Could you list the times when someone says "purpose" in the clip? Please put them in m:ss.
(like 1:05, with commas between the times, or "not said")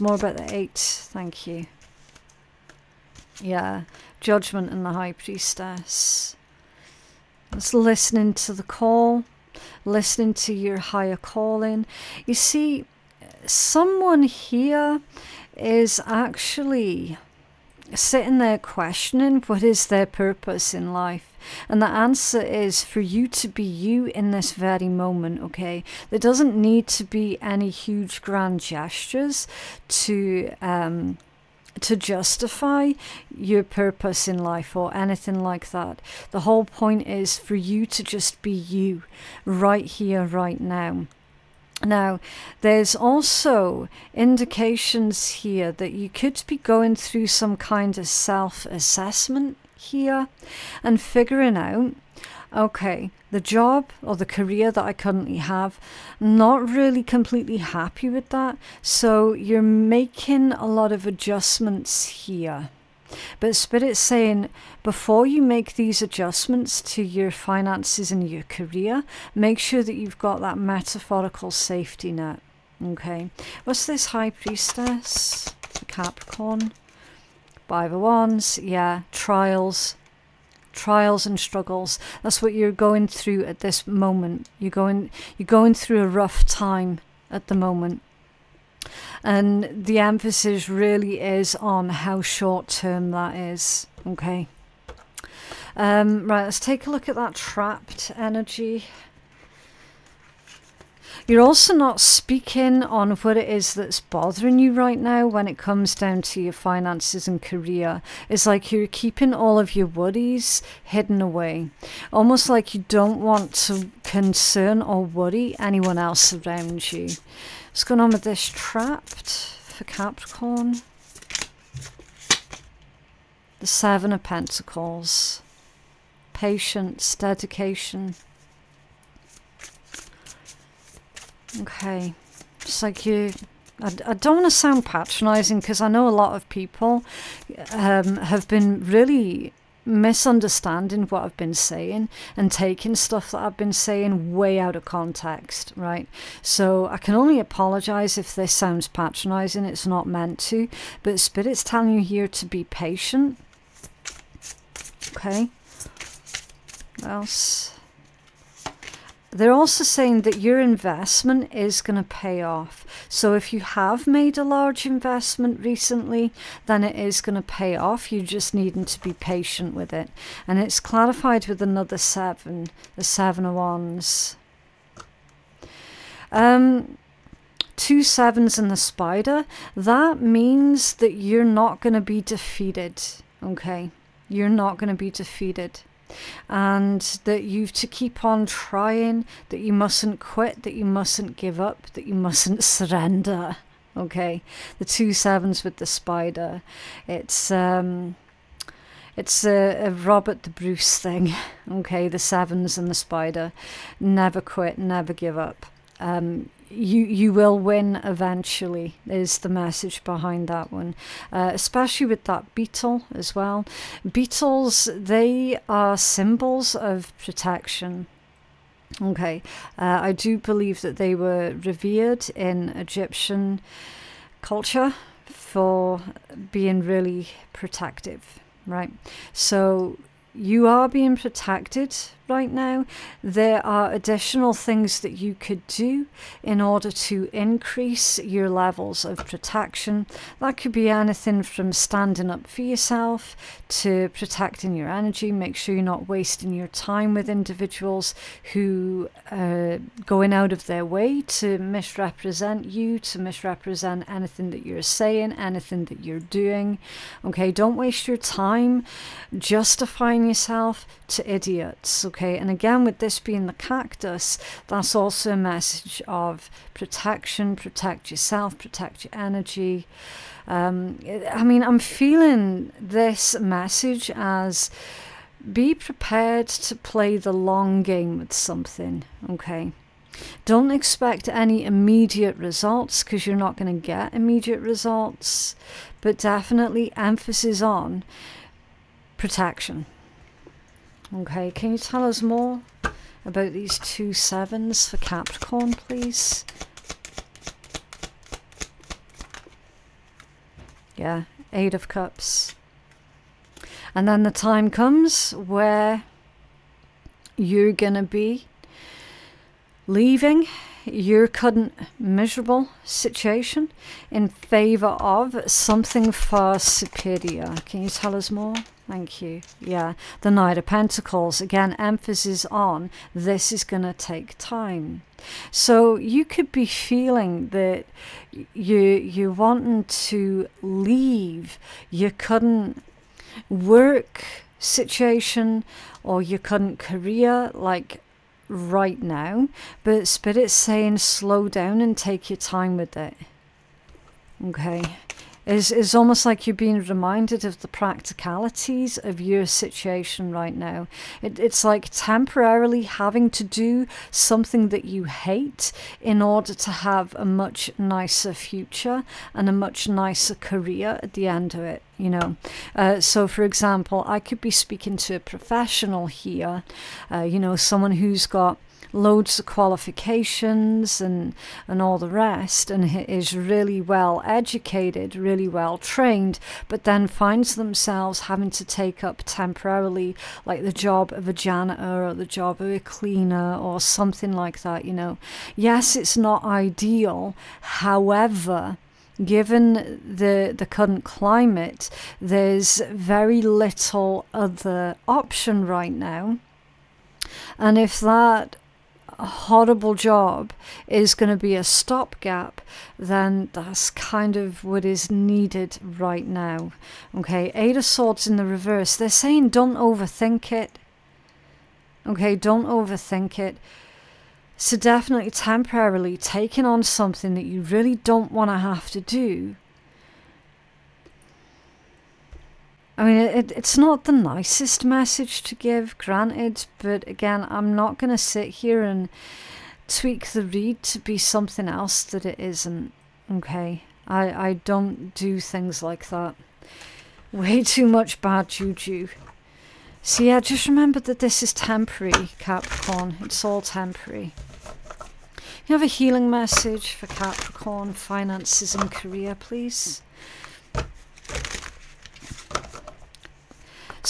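0:20, 0:33.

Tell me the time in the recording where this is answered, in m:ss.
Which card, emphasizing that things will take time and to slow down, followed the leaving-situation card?
5:20.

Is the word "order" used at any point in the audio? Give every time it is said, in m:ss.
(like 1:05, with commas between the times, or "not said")
3:56, 5:56.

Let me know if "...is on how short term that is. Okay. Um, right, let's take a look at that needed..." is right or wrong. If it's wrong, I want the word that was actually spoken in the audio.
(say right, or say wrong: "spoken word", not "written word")
wrong: "trapped", not "needed".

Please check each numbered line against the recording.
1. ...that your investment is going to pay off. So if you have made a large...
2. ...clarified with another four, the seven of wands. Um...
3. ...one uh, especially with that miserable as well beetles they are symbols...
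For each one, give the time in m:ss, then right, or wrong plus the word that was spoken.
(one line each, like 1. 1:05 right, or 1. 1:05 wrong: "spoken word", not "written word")
1. 2:40 right
2. 2:50 wrong: "seven", not "four"
3. 3:30 wrong: "beetle", not "miserable".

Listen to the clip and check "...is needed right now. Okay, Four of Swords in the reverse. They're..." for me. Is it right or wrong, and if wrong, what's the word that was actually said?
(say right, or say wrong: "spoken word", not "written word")
wrong: "Eight", not "Four".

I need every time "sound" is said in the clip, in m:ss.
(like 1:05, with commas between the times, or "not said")
2:14, 2:28.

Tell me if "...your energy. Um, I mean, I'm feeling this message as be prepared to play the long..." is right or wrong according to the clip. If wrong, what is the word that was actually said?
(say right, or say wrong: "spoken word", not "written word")
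right.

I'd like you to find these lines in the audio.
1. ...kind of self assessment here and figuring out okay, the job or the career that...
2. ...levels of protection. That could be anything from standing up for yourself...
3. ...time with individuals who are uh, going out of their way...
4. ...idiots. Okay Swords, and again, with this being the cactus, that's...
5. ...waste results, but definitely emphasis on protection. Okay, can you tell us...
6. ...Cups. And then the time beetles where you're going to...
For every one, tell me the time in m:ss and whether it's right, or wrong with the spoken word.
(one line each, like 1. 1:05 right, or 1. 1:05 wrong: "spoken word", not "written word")
1. 0:47 right
2. 3:58 right
3. 4:06 right
4. 4:21 wrong: "Okay", not "Swords"
5. 4:44 wrong: "immediate", not "waste"
6. 5:01 wrong: "comes", not "beetles".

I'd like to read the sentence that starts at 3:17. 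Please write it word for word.
It's um, it's a, a, Robert the Bruce thing.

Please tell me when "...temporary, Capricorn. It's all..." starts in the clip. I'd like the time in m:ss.
7:21.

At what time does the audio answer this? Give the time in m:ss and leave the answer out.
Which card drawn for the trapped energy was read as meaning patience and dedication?
2:03.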